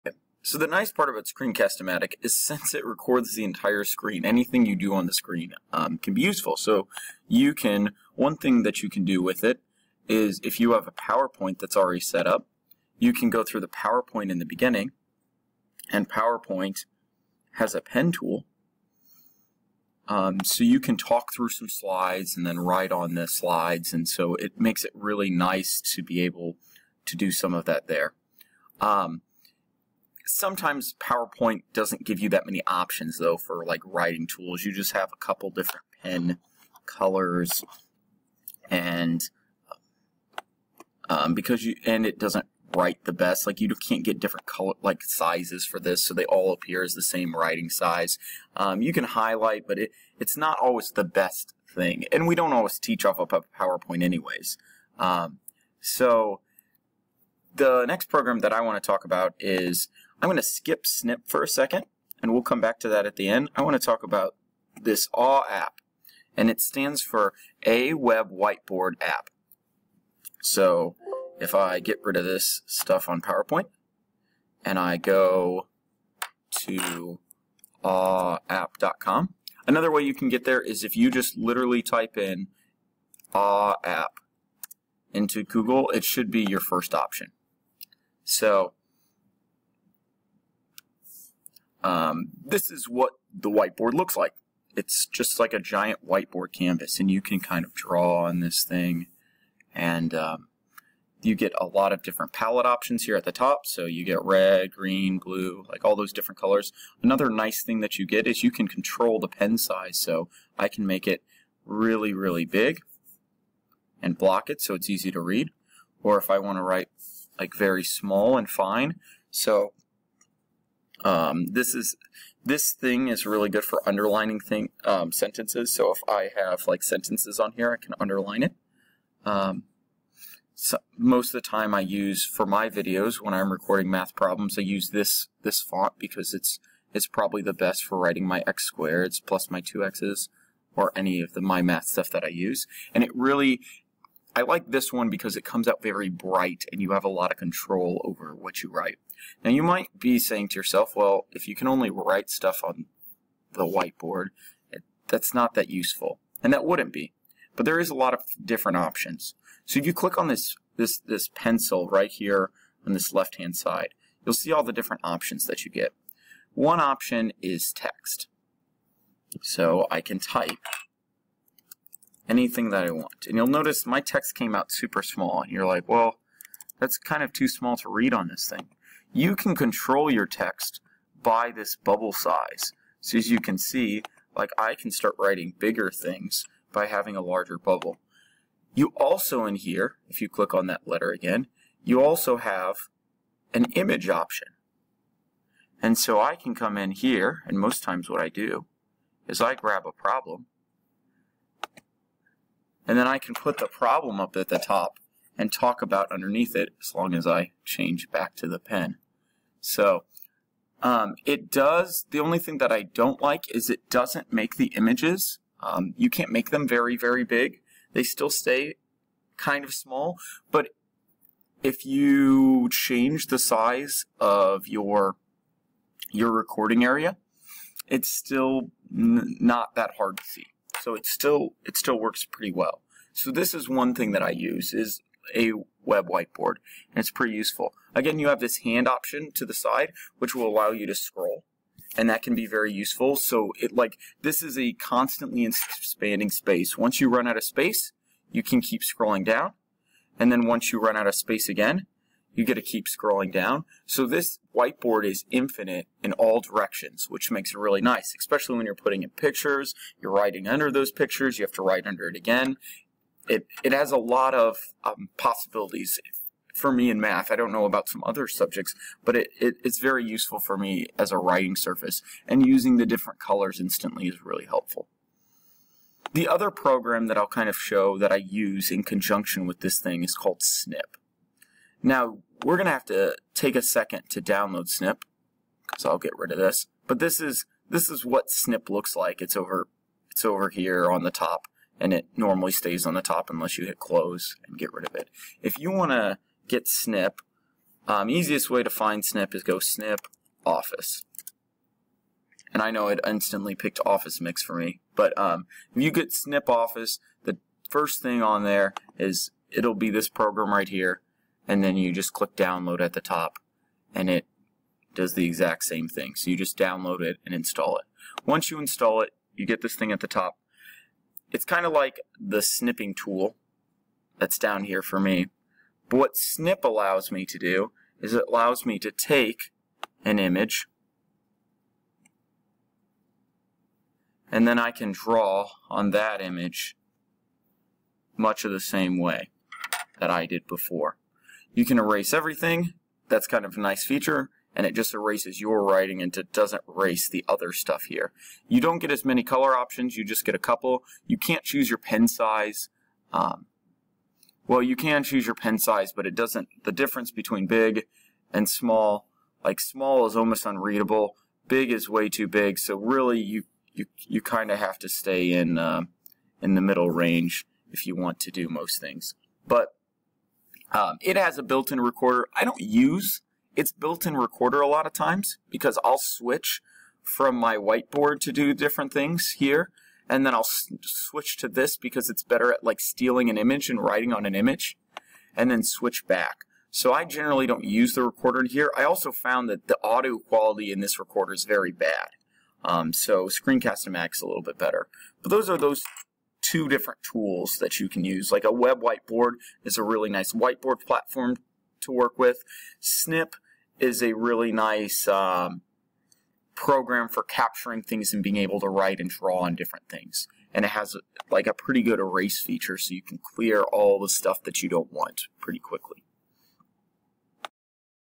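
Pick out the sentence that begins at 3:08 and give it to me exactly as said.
You also in here, if you click on that letter again, you also have an image option.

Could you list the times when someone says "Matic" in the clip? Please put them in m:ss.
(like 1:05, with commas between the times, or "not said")
0:01, 6:33.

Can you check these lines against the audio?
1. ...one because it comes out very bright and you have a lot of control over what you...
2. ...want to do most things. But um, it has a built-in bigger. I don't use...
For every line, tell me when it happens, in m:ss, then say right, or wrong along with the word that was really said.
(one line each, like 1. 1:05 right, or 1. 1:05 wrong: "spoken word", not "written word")
1. 2:24 right
2. 6:07 wrong: "recorder", not "bigger".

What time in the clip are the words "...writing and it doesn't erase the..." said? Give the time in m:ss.
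5:45.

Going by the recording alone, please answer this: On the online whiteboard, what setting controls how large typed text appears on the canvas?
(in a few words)
bubble size.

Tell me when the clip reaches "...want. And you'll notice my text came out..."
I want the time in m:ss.
2:52.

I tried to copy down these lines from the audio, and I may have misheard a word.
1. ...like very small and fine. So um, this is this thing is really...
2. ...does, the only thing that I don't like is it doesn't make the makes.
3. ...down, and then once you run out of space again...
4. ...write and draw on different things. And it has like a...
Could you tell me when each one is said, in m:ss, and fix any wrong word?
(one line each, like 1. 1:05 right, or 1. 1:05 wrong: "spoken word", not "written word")
1. 1:57 right
2. 3:31 wrong: "images", not "makes"
3. 4:09 right
4. 6:48 right.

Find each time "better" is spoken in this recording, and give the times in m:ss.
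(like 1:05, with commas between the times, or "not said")
6:22, 6:34.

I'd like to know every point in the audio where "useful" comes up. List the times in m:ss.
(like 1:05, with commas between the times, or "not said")
0:06, 2:35, 3:57, 4:02, 4:30.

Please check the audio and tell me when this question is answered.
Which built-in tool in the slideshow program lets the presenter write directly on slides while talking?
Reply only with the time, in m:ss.
0:17.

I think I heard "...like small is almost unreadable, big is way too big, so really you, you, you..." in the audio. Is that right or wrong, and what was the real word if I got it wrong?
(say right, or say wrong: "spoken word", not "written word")
right.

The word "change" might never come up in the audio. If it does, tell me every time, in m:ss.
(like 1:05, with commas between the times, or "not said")
3:27, 3:42.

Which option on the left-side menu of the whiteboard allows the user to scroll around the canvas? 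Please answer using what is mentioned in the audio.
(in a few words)
hand option.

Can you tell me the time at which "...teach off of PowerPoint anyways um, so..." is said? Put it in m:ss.
0:52.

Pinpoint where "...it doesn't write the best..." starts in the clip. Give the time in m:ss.
0:42.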